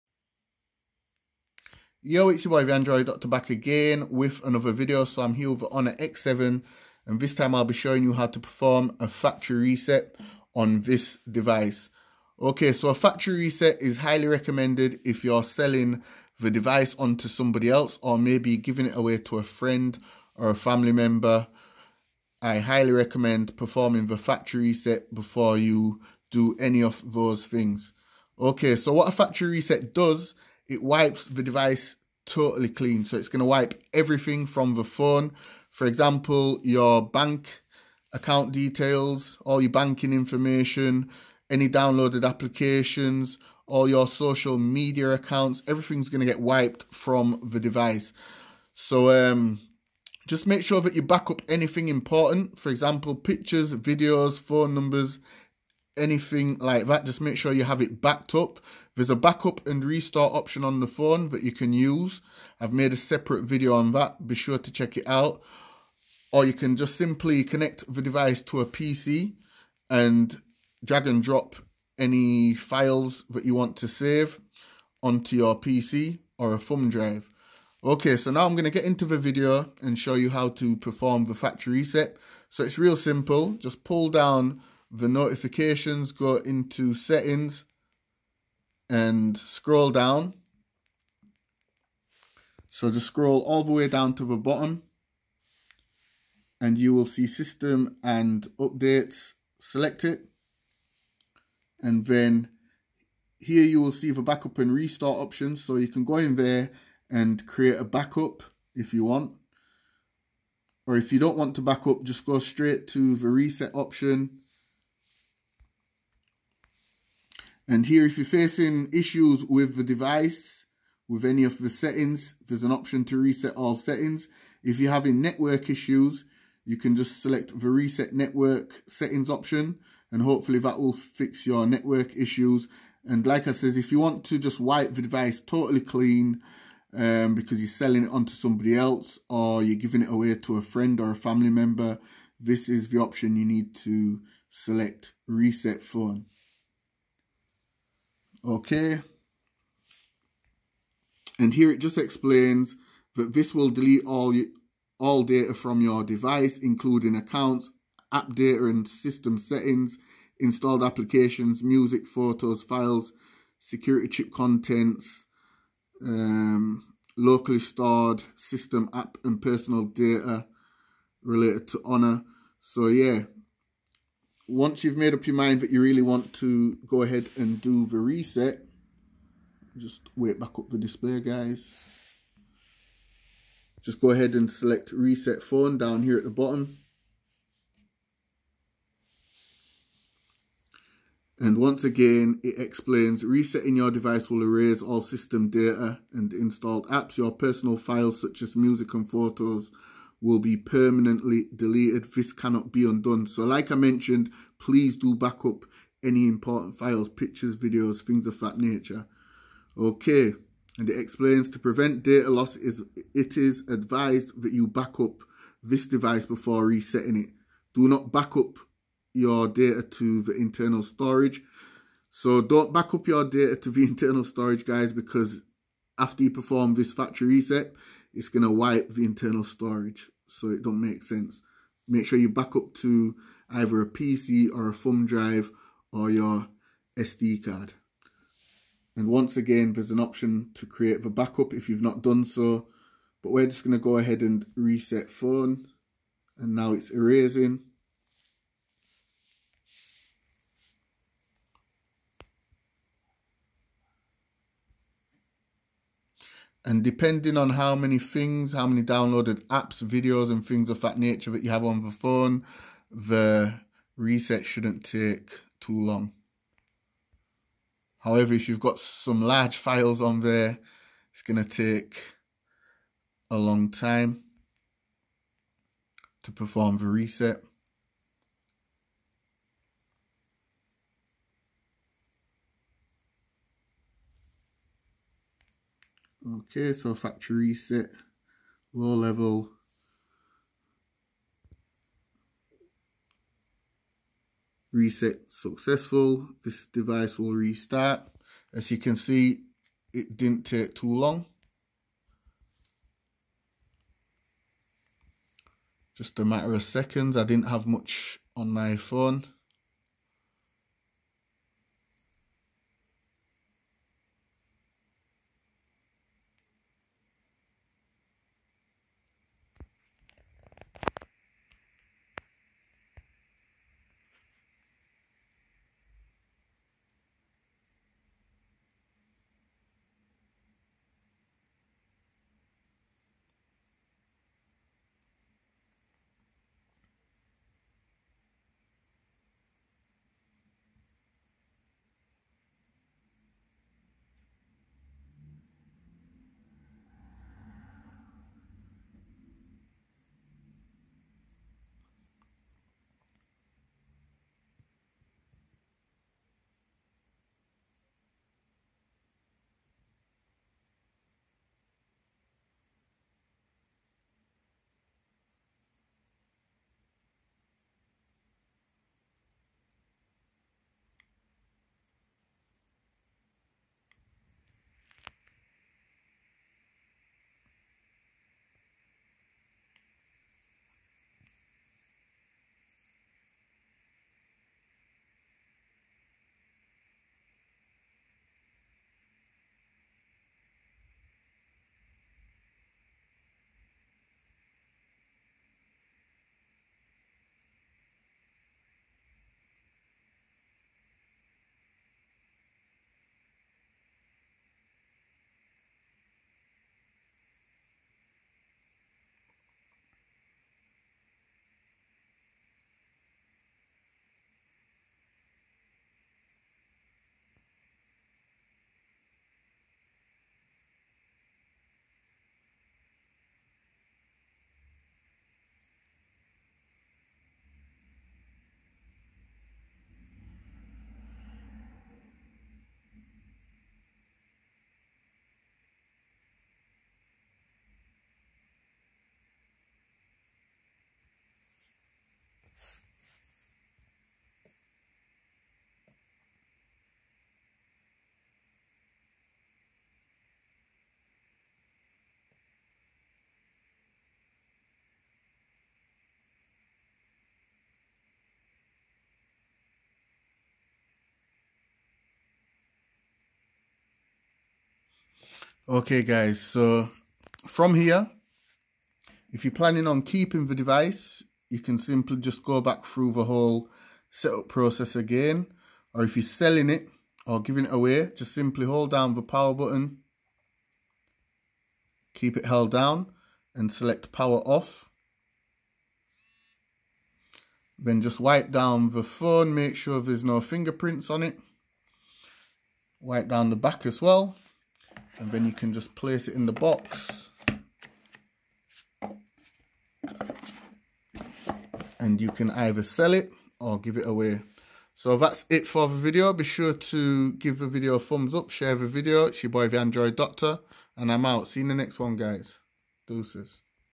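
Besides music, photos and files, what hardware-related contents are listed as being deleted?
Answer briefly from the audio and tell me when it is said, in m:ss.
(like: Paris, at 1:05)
Security chip contents, at 2:43.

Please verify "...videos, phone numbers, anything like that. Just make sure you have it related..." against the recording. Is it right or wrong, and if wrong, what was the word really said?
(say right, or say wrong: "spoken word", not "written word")
wrong: "backed", not "related".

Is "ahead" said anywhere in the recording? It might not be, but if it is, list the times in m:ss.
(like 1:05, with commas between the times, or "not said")
2:57, 3:04, 4:03.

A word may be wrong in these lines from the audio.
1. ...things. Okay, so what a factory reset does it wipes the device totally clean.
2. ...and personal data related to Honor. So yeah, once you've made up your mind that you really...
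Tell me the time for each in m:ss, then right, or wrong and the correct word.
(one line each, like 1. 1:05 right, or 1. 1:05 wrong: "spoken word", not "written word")
1. 0:27 right
2. 2:49 right.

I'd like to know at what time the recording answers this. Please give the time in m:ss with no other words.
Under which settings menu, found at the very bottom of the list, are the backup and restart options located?
1:37.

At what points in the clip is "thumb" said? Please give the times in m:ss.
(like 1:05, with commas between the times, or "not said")
1:16, 3:54, 8:27.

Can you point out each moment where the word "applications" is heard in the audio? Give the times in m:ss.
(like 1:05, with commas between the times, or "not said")
0:42, 2:40.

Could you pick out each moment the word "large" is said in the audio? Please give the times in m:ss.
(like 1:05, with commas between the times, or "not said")
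4:29.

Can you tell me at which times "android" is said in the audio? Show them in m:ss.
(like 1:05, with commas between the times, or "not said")
0:02, 8:29.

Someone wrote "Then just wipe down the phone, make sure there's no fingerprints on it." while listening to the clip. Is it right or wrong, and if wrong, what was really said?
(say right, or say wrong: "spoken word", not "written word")
right.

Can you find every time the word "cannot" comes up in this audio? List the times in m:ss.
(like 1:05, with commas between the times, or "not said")
3:22.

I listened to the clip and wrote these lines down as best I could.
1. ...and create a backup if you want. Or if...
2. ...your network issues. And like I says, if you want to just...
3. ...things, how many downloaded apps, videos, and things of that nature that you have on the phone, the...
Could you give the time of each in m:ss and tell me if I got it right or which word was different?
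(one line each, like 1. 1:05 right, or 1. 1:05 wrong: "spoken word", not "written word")
1. 1:47 right
2. 2:11 right
3. 4:17 right.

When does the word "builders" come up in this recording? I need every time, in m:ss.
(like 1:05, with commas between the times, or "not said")
not said.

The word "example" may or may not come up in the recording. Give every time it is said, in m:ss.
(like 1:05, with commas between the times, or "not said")
0:35, 0:52.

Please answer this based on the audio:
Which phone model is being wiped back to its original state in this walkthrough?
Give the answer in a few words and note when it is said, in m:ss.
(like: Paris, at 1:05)
Honor X7, at 0:05.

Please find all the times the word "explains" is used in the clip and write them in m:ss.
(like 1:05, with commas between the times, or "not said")
2:31, 3:12, 3:30.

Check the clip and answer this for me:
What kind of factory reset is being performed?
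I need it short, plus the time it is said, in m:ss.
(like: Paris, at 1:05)
Low level, at 4:48.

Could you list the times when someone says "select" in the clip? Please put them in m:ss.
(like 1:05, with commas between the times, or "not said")
1:39, 2:07, 2:24, 3:04, 8:03.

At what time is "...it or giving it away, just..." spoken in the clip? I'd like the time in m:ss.
7:56.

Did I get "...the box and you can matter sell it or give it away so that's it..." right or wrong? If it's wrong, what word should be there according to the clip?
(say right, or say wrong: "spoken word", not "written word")
wrong: "either", not "matter".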